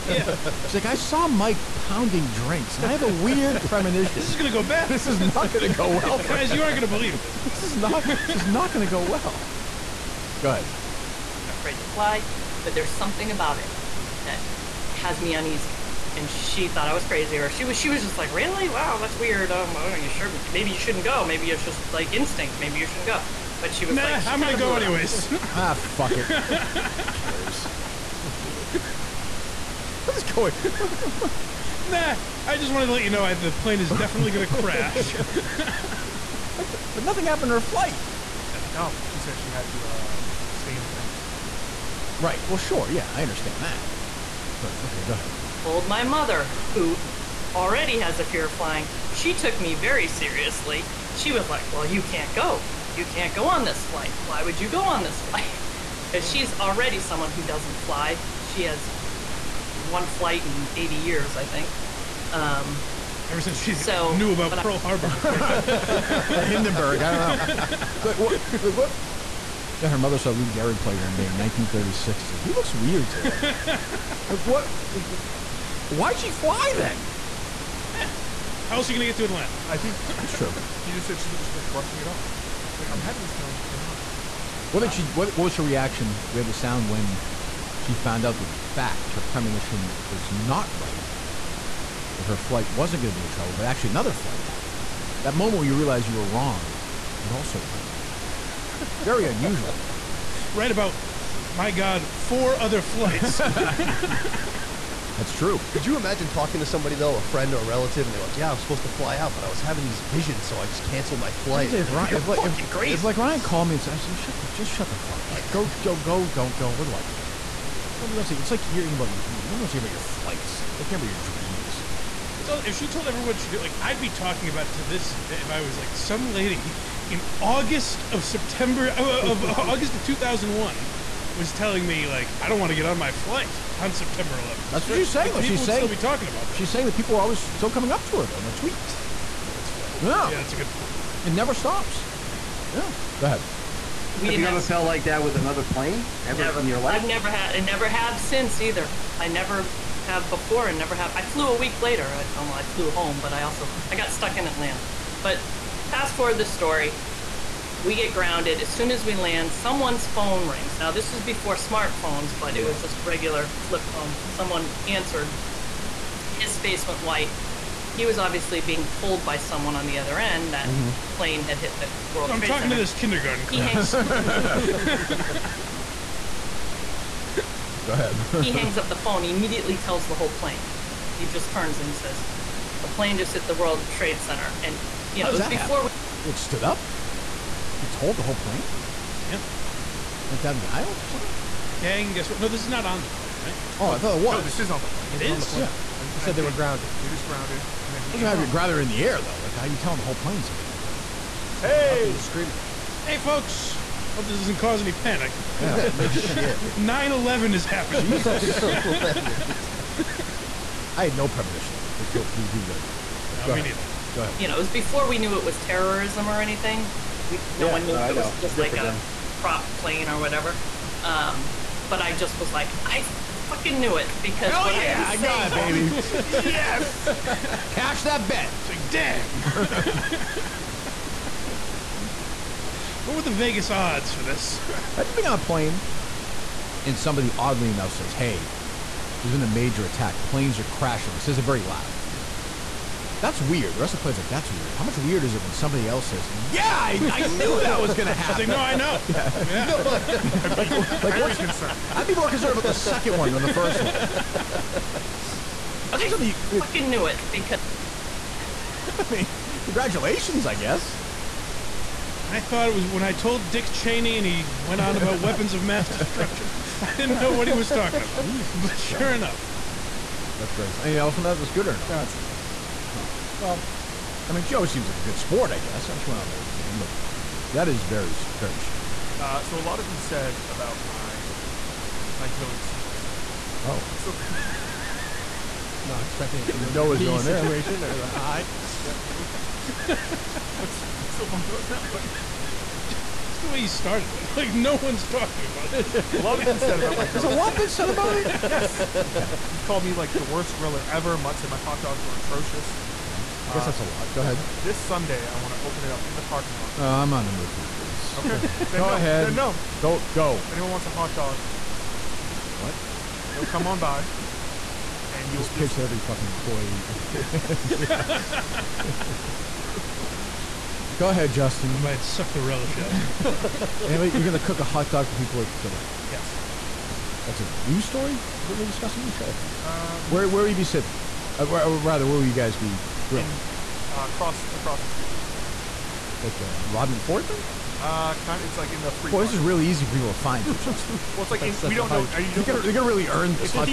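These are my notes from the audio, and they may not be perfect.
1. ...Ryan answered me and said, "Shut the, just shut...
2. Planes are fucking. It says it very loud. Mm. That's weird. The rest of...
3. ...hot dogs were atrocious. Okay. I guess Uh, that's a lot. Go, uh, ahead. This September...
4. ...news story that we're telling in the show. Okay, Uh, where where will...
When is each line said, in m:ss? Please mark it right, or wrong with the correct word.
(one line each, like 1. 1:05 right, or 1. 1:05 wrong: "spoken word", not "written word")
1. 1:53 wrong: "called", not "answered"
2. 4:00 wrong: "crashing", not "fucking"
3. 5:01 wrong: "Sunday", not "September"
4. 5:27 wrong: "discussing", not "telling".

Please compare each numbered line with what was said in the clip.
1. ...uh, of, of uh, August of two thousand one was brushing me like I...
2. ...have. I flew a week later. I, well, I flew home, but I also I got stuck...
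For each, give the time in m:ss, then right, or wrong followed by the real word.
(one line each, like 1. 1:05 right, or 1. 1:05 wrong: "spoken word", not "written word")
1. 2:08 wrong: "telling", not "brushing"
2. 2:30 right.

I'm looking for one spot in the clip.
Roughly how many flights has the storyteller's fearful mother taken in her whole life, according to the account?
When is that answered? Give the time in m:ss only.
0:59.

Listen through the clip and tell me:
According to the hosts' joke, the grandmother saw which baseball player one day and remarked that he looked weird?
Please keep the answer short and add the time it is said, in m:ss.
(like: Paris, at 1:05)
Lou Gehrig, at 1:10.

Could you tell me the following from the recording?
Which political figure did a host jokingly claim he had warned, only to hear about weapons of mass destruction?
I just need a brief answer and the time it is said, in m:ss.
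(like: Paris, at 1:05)
Dick Cheney, at 4:23.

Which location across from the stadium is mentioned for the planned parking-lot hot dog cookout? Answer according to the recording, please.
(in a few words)
Rodman Ford.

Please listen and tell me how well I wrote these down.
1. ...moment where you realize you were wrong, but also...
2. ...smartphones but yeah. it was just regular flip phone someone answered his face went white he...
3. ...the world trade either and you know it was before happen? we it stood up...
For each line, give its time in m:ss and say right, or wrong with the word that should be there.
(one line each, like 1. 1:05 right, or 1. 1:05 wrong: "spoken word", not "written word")
1. 1:35 right
2. 2:41 right
3. 3:03 wrong: "center", not "either".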